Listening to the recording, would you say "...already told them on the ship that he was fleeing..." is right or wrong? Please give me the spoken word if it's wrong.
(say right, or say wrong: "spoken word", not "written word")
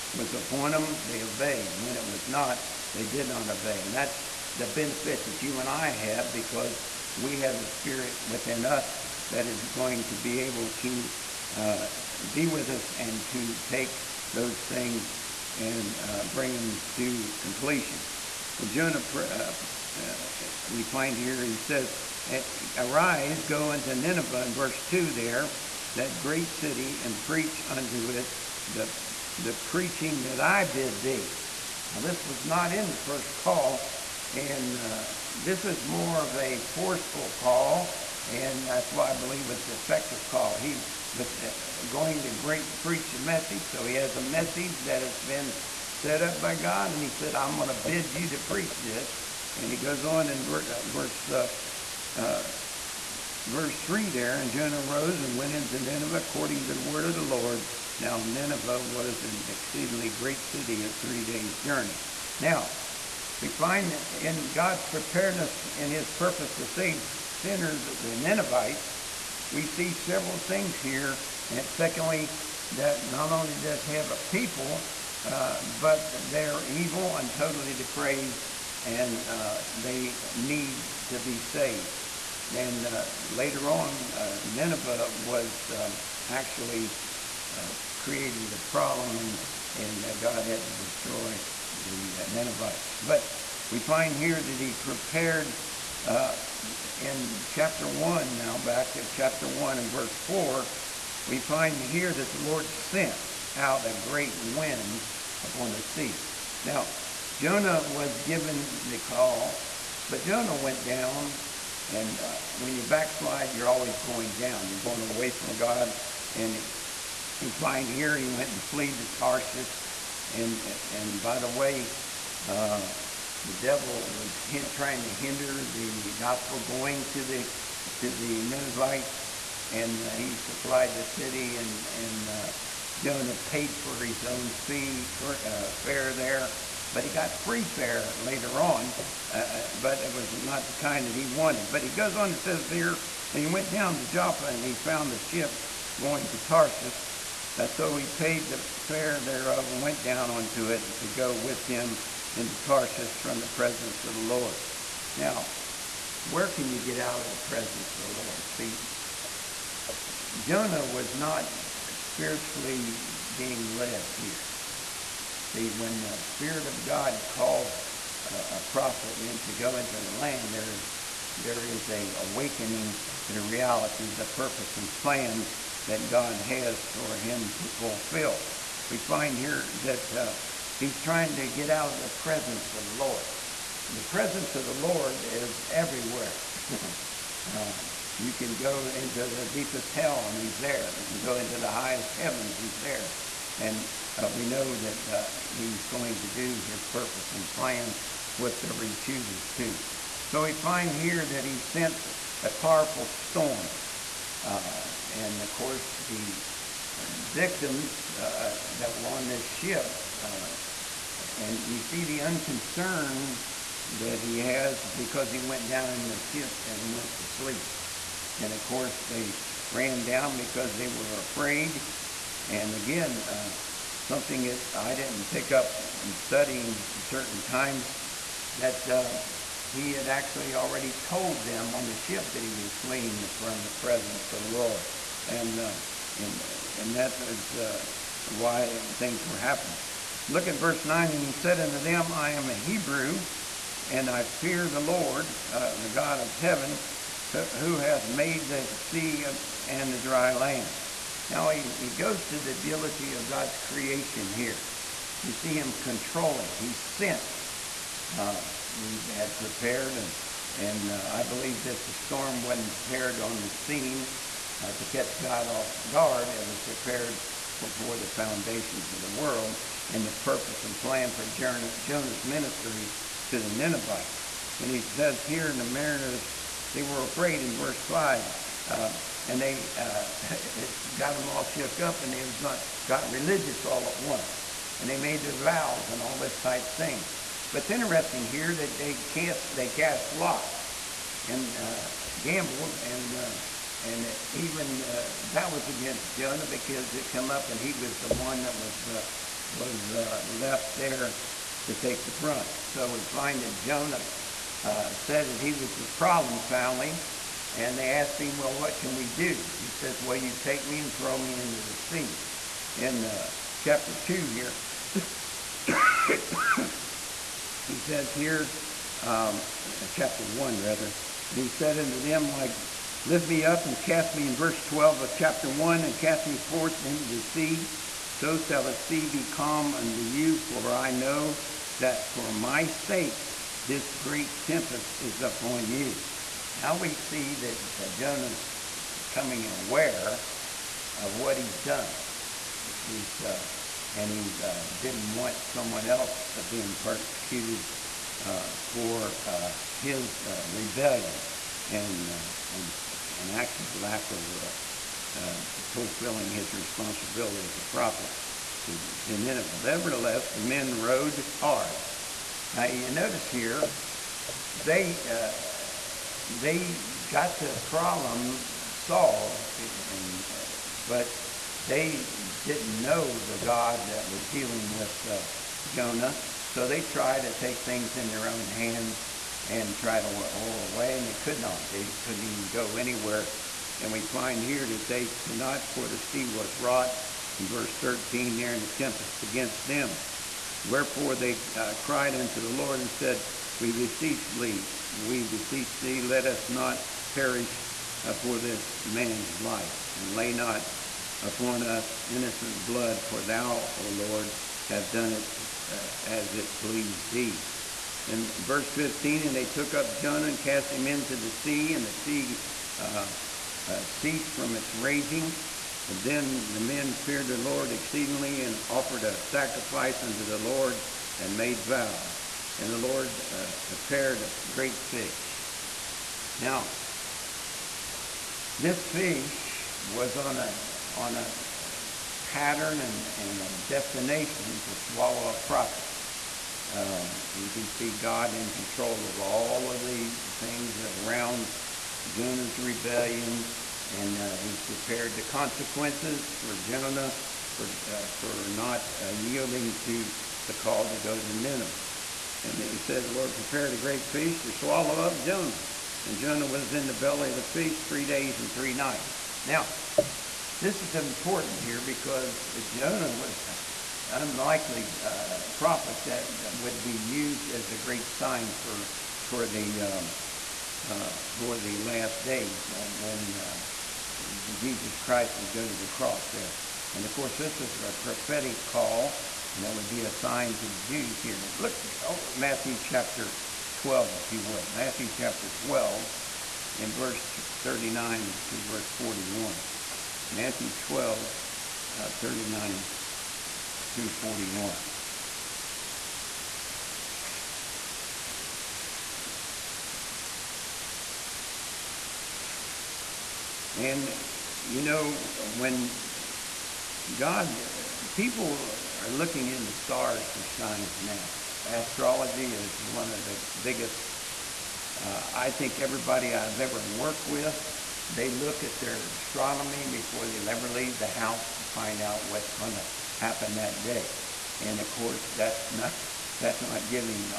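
right.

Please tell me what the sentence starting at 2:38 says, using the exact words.
See, Jonah was not spiritually being led here.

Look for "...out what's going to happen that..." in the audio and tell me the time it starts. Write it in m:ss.
8:41.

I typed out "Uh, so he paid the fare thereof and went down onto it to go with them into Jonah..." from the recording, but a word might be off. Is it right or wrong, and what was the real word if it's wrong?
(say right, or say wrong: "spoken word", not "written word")
wrong: "Tarsus", not "Jonah".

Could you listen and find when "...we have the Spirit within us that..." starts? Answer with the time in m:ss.
0:07.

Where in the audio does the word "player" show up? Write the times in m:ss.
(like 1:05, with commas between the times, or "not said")
not said.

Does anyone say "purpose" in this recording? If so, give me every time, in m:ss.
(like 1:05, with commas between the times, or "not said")
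1:06, 2:54, 3:16, 4:30.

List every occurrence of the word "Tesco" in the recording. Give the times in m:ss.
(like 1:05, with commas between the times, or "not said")
not said.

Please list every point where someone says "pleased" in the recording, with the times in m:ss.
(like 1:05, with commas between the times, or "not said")
6:46.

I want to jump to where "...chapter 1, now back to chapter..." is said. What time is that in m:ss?
1:37.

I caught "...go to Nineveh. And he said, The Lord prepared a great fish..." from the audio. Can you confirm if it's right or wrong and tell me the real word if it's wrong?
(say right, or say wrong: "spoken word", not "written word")
right.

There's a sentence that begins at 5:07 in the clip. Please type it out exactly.
And they asked him, well, what can we do?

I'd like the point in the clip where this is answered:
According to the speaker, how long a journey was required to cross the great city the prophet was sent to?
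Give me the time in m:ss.
1:00.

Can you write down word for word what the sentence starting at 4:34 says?
And he says here in the mariner's they were afraid in verse 5.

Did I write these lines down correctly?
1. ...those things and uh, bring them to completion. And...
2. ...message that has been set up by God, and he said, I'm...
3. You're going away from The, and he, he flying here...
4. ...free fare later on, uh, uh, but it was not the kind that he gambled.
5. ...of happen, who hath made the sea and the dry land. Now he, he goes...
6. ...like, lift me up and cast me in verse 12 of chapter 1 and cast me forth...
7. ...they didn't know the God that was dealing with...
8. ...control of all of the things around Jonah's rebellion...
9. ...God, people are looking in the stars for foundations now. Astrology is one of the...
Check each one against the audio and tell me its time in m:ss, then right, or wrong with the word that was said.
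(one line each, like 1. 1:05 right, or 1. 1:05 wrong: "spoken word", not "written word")
1. 0:14 right
2. 0:44 right
3. 1:54 wrong: "God", not "The"
4. 2:17 wrong: "wanted", not "gambled"
5. 4:06 wrong: "heaven", not "happen"
6. 5:22 right
7. 6:11 right
8. 7:18 right
9. 8:27 wrong: "signs", not "foundations".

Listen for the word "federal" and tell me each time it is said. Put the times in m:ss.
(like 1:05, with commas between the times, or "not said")
not said.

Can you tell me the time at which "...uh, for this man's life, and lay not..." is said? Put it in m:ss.
6:38.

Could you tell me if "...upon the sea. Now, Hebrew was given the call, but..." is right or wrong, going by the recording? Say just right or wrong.
wrong.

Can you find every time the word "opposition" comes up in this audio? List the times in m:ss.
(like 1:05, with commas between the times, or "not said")
not said.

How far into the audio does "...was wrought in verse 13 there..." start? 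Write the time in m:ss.
6:26.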